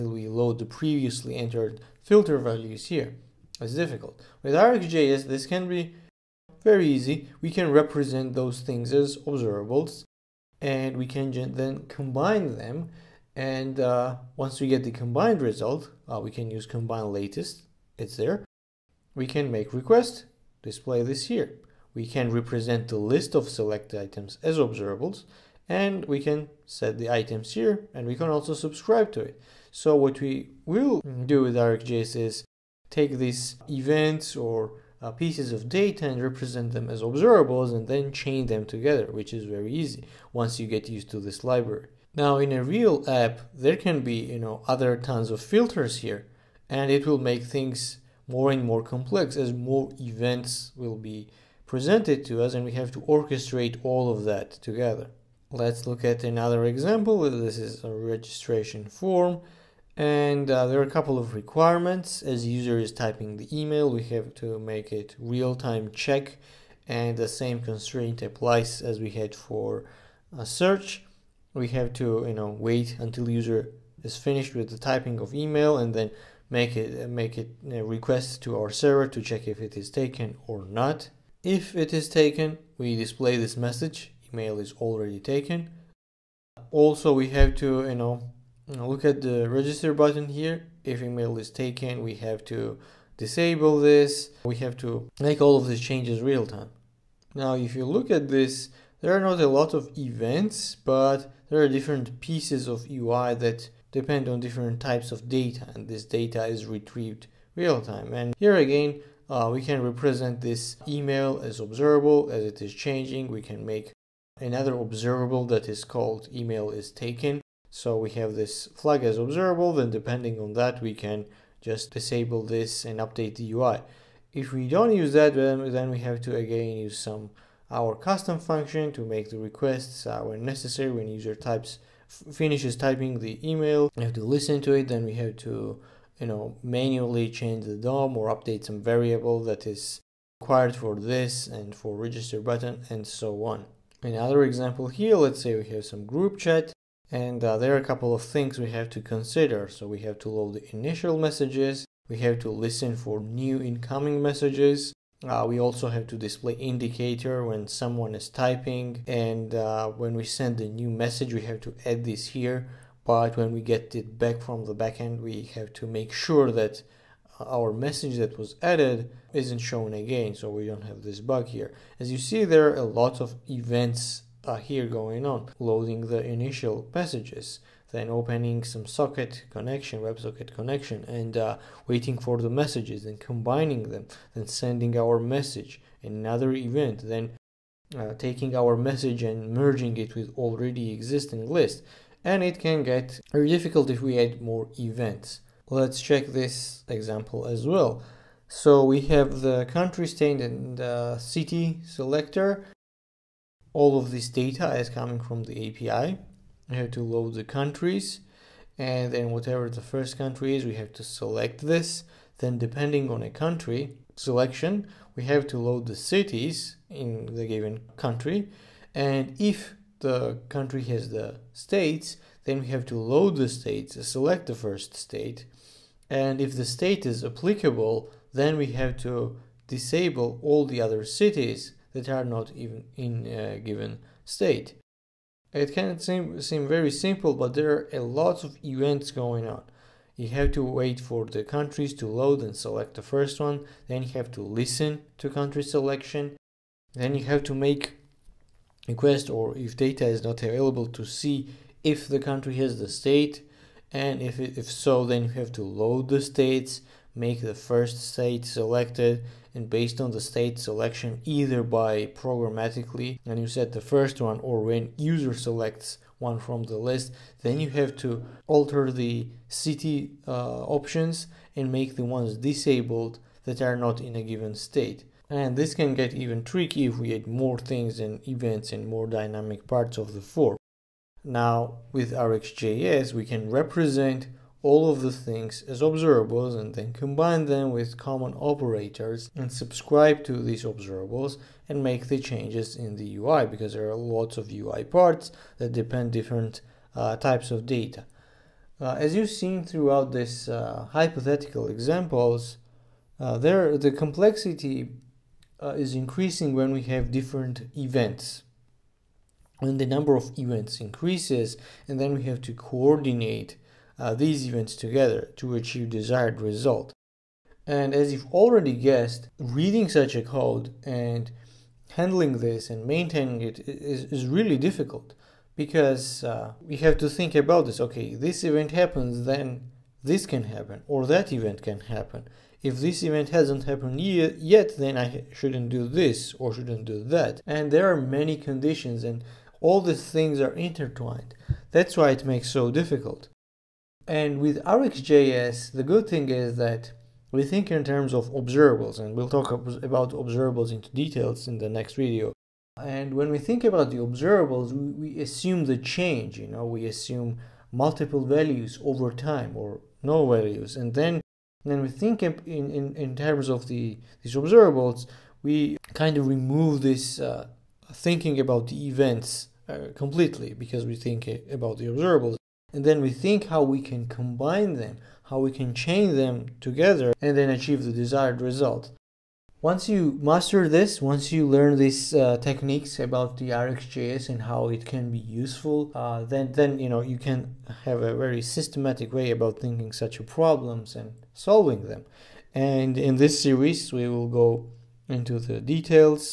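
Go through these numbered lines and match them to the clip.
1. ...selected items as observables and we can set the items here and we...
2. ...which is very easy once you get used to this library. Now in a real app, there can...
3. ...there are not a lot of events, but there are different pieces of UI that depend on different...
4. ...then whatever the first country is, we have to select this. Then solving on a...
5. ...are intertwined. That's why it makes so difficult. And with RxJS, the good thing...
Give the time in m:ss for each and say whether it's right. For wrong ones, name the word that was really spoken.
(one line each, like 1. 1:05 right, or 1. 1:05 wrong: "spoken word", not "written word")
1. 0:23 right
2. 0:39 right
3. 1:39 right
4. 3:29 wrong: "depending", not "solving"
5. 5:40 right.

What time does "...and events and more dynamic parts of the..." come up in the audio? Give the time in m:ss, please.
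4:37.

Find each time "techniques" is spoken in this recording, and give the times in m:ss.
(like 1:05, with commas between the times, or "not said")
6:22.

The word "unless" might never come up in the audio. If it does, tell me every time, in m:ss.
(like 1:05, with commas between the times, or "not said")
not said.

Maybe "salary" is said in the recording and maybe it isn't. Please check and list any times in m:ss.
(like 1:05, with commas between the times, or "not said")
not said.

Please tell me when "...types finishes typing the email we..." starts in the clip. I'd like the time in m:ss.
2:11.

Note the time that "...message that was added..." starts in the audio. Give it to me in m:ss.
2:47.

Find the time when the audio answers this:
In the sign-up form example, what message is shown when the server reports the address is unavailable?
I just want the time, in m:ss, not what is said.
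1:24.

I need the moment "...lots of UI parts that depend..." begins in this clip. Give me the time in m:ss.
4:53.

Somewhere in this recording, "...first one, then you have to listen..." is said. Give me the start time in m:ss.
4:03.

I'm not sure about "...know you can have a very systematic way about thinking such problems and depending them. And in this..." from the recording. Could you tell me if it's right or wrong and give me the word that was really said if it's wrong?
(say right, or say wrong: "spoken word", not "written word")
wrong: "solving", not "depending".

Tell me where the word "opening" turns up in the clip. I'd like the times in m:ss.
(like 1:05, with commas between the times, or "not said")
2:58.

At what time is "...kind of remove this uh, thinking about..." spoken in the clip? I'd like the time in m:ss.
6:05.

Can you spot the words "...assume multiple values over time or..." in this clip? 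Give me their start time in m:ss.
5:56.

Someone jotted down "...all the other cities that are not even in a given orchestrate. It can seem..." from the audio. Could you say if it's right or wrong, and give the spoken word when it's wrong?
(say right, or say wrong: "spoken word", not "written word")
wrong: "state", not "orchestrate".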